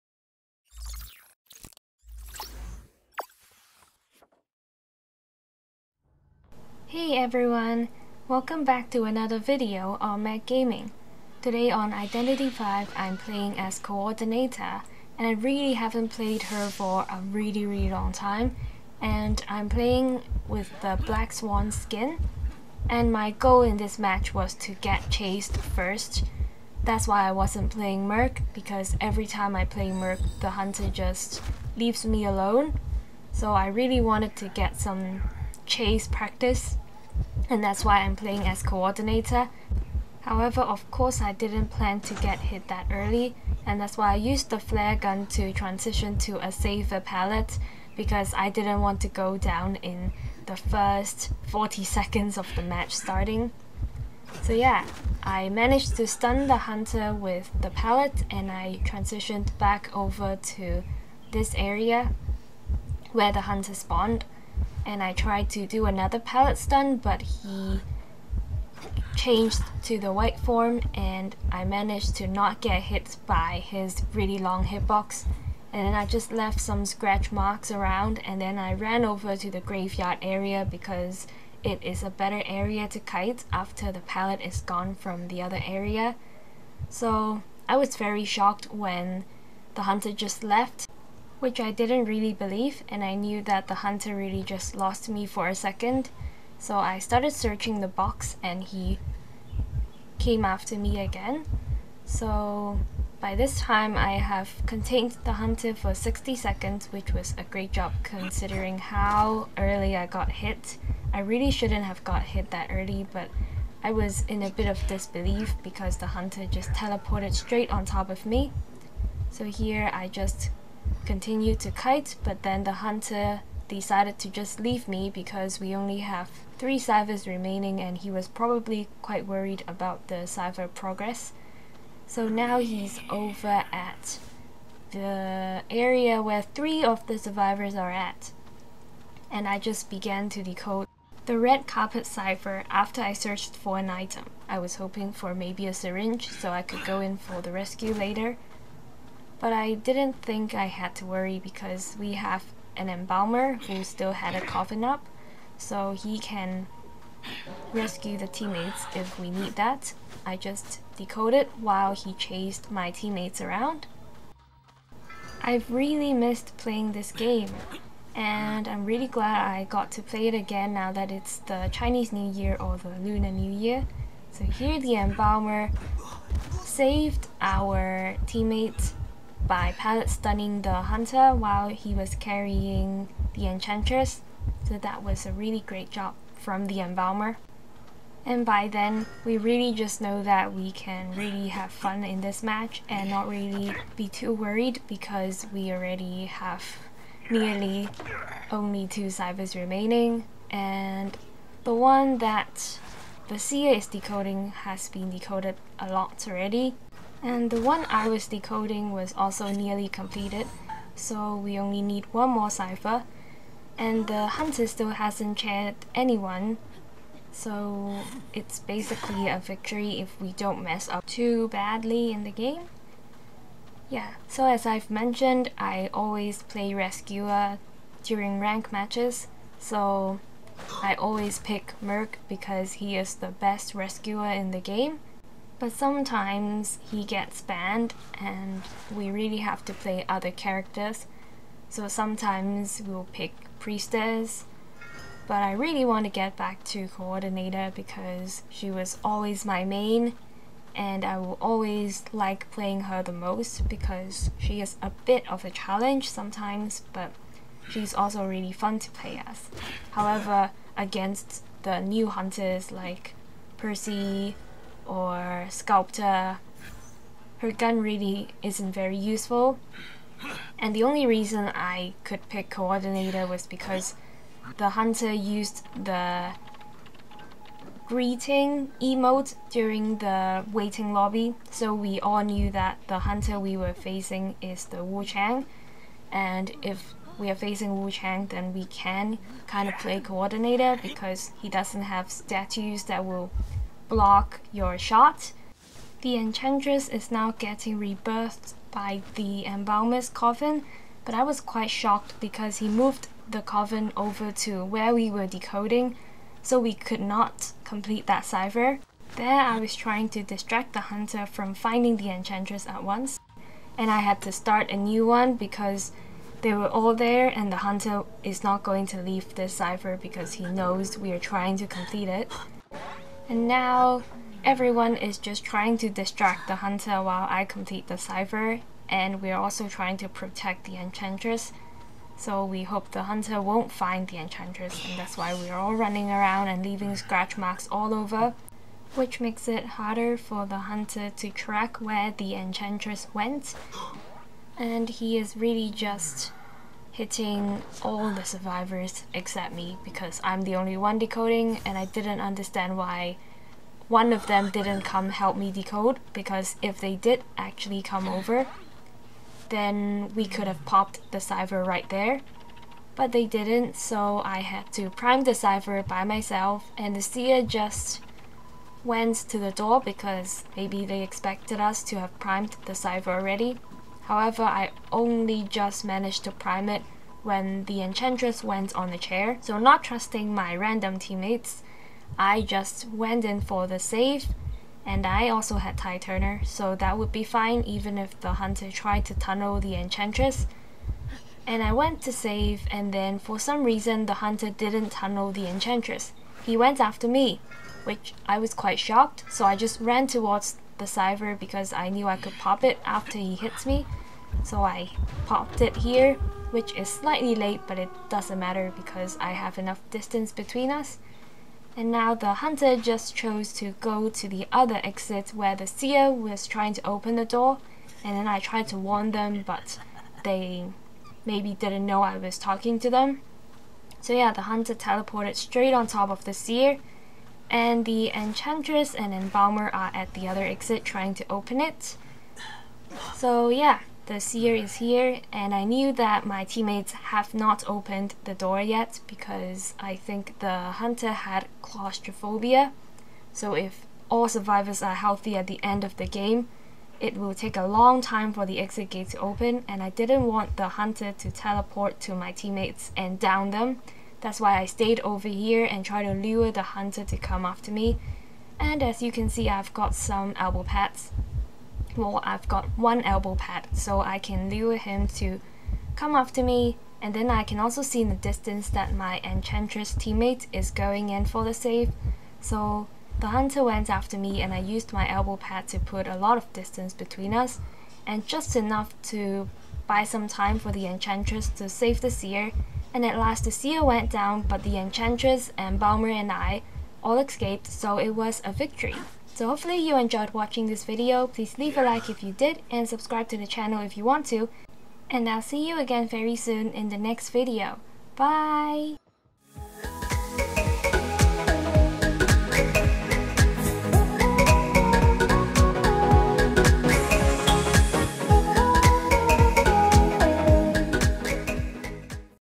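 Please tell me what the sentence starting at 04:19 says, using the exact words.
However, against the new hunters like Percy, or sculptor, her gun really isn't very useful.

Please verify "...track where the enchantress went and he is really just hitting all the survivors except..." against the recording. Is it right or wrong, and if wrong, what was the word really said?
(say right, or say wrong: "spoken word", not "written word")
right.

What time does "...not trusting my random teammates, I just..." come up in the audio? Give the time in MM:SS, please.
06:19.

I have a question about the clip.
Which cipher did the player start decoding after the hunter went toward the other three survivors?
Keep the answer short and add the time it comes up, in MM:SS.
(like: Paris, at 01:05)
red carpet cipher, at 02:21.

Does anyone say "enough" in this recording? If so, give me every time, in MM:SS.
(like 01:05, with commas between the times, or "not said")
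06:49, 07:58.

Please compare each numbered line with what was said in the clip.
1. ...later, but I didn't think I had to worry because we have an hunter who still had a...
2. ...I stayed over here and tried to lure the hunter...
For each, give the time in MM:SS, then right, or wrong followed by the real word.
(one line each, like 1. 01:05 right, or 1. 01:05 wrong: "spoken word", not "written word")
1. 02:27 wrong: "embalmer", not "hunter"
2. 07:34 right.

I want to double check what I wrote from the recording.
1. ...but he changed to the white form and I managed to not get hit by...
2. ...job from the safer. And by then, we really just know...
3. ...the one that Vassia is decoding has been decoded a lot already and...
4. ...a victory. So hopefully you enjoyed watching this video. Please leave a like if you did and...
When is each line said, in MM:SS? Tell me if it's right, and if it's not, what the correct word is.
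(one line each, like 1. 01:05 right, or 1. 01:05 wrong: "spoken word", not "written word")
1. 01:06 right
2. 03:05 wrong: "embalmer", not "safer"
3. 03:21 right
4. 08:08 right.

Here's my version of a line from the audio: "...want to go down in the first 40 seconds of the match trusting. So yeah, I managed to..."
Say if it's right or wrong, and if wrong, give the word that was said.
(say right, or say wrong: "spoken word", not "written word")
wrong: "starting", not "trusting".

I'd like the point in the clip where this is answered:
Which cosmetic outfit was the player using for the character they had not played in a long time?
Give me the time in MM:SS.
00:21.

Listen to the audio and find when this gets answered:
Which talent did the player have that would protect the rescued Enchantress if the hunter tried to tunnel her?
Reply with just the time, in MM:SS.
06:25.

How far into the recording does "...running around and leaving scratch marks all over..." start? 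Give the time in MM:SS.
05:35.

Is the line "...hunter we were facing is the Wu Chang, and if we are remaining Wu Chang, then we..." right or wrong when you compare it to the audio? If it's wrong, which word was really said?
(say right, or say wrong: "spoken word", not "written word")
wrong: "facing", not "remaining".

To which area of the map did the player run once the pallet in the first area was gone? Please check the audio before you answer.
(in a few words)
graveyard.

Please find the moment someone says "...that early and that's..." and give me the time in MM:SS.
00:42.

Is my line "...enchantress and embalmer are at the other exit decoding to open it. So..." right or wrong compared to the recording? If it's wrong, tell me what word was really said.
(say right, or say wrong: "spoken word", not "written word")
wrong: "trying", not "decoding".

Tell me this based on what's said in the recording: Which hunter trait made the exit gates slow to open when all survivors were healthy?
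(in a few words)
claustrophobia.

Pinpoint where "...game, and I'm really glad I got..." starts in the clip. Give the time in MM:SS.
02:47.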